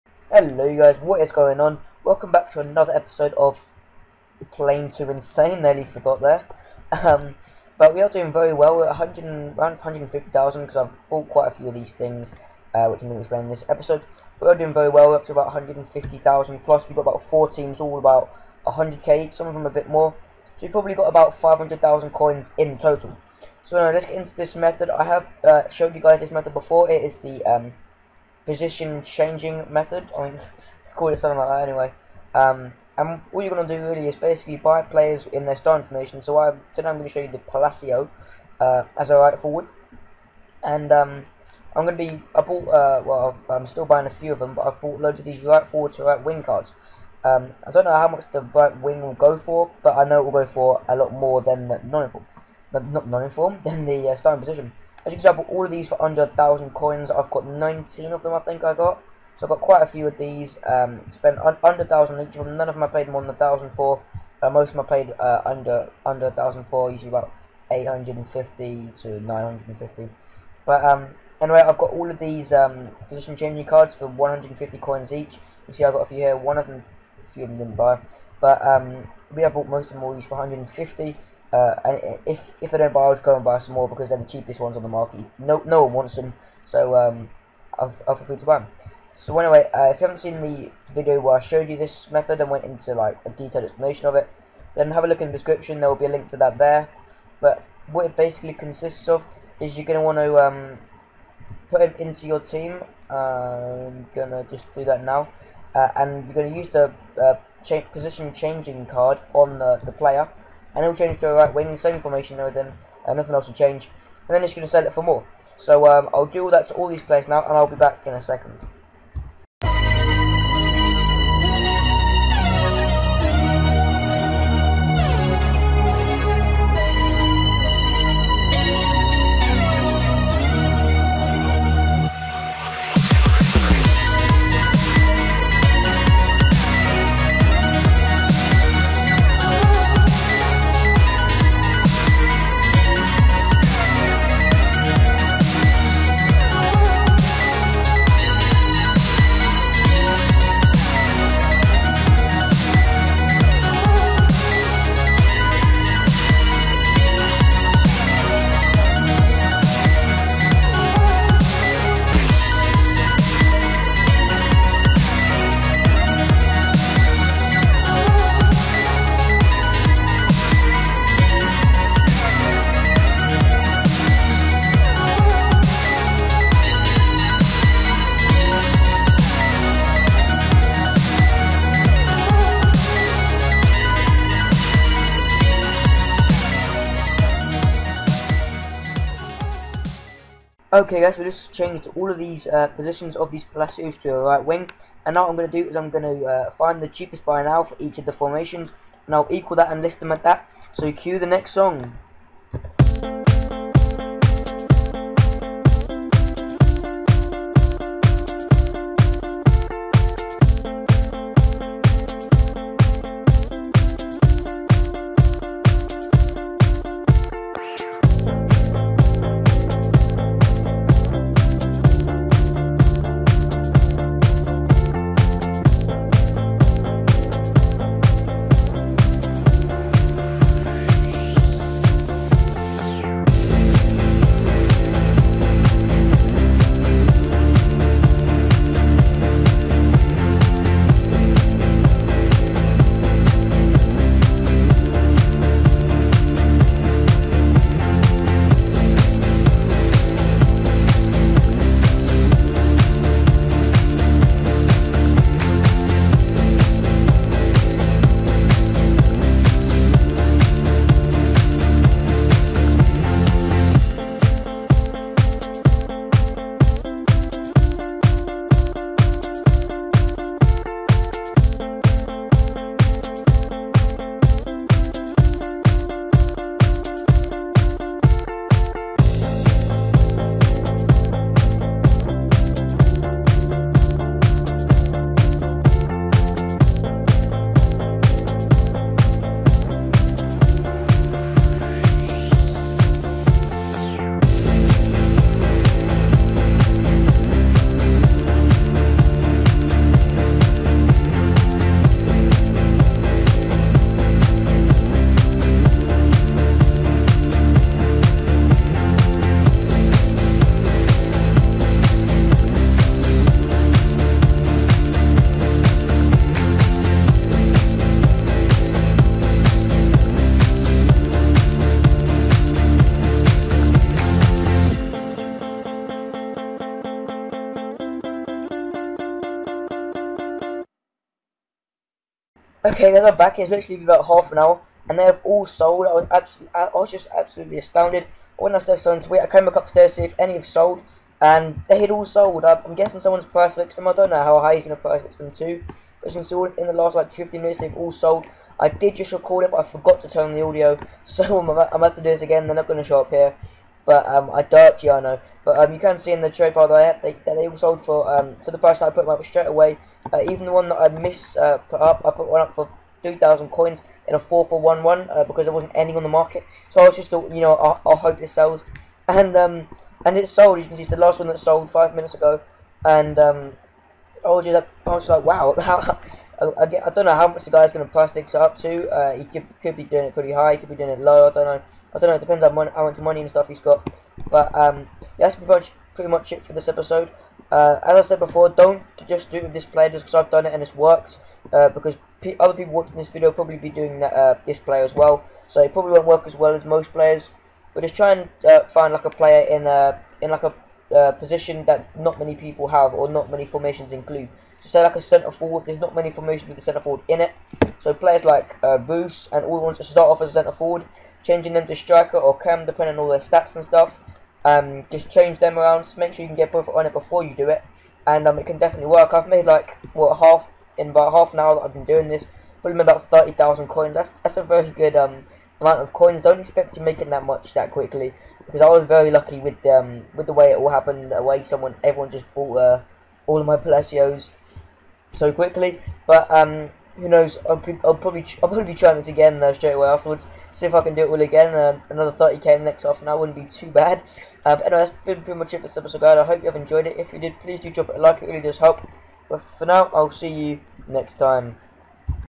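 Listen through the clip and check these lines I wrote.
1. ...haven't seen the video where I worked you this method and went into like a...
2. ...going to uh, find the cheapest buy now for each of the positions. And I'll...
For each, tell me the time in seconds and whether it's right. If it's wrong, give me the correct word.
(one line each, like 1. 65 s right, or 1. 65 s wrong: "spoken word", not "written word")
1. 90 s wrong: "showed", not "worked"
2. 195 s wrong: "formations", not "positions".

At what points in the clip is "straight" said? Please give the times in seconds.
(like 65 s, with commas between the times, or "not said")
359 s, 439 s.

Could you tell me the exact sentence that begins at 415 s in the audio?
Just make sure you can get both on it before you do it, and um, it can definitely work.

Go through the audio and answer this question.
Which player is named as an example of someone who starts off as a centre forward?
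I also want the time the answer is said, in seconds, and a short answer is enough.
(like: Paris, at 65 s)
Bruce, at 408 s.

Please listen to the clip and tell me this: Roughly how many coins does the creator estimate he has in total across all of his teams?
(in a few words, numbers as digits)
500,000.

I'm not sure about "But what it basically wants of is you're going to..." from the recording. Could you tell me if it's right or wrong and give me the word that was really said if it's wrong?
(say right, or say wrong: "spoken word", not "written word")
wrong: "consists", not "wants".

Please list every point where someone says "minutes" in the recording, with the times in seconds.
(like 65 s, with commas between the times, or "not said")
347 s, 371 s.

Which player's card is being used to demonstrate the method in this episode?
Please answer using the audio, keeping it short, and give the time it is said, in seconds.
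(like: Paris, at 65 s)
Palacio, at 37 s.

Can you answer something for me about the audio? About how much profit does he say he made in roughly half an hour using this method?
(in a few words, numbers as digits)
30,000 coins.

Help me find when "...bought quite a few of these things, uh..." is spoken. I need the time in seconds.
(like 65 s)
11 s.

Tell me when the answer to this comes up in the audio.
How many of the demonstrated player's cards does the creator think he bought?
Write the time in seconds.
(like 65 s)
57 s.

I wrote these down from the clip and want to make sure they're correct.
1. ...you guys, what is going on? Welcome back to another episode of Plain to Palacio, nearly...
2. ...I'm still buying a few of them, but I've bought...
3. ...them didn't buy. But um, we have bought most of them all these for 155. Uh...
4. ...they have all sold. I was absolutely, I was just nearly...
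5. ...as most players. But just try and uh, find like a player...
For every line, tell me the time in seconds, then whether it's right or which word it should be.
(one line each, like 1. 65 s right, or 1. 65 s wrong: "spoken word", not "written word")
1. 0 s wrong: "Insane", not "Palacio"
2. 43 s right
3. 77 s wrong: "150", not "155"
4. 334 s wrong: "absolutely", not "nearly"
5. 396 s right.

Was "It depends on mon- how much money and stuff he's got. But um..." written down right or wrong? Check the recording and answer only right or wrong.
right.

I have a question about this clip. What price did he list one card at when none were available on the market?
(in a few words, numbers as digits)
2,000 coins.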